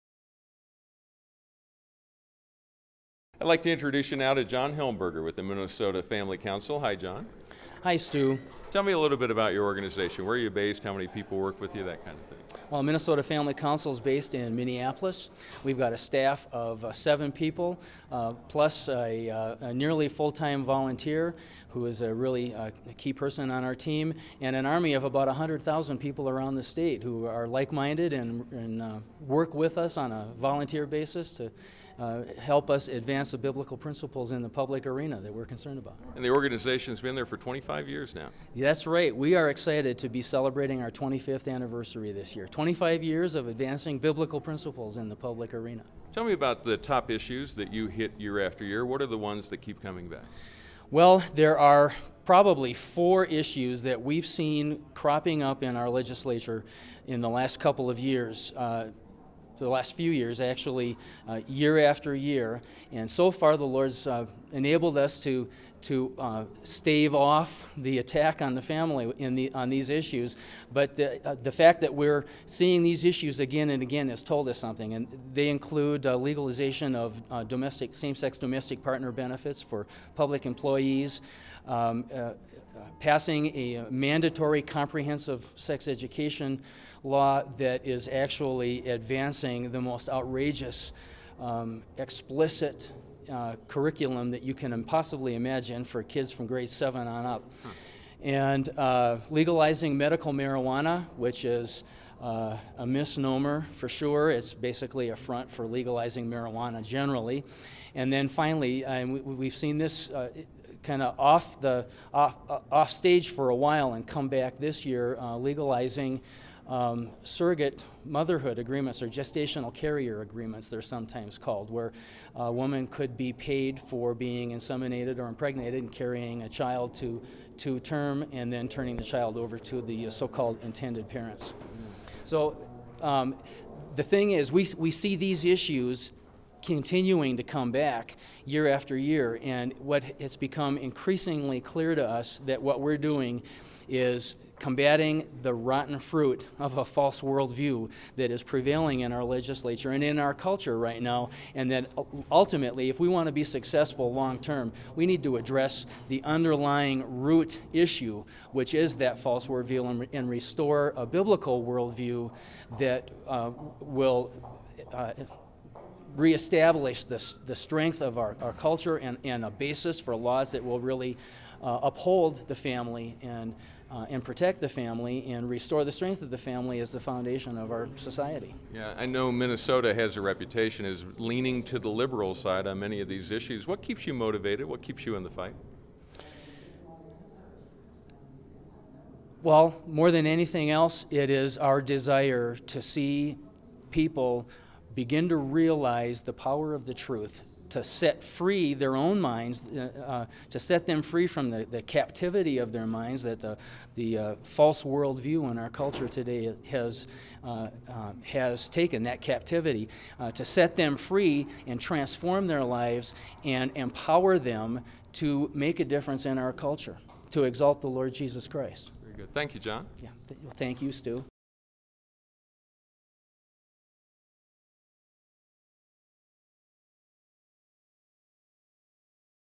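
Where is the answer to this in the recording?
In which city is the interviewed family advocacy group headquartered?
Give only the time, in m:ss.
0:14.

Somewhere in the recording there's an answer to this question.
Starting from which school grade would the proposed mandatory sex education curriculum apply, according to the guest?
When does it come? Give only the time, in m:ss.
1:36.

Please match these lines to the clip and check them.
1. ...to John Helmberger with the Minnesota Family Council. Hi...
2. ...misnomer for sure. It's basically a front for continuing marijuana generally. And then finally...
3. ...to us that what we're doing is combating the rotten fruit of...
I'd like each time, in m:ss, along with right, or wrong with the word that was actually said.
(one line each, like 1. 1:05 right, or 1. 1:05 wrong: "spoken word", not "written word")
1. 0:04 right
2. 1:42 wrong: "legalizing", not "continuing"
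3. 2:21 right.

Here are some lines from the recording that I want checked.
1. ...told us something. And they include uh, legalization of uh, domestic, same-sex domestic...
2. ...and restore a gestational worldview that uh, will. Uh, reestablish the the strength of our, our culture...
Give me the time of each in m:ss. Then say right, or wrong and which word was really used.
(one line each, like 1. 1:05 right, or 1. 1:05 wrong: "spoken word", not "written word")
1. 1:14 right
2. 2:40 wrong: "biblical", not "gestational".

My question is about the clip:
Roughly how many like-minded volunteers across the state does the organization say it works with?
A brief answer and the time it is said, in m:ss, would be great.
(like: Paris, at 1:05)
100,000, at 0:25.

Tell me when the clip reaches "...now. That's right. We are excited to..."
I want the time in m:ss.
0:38.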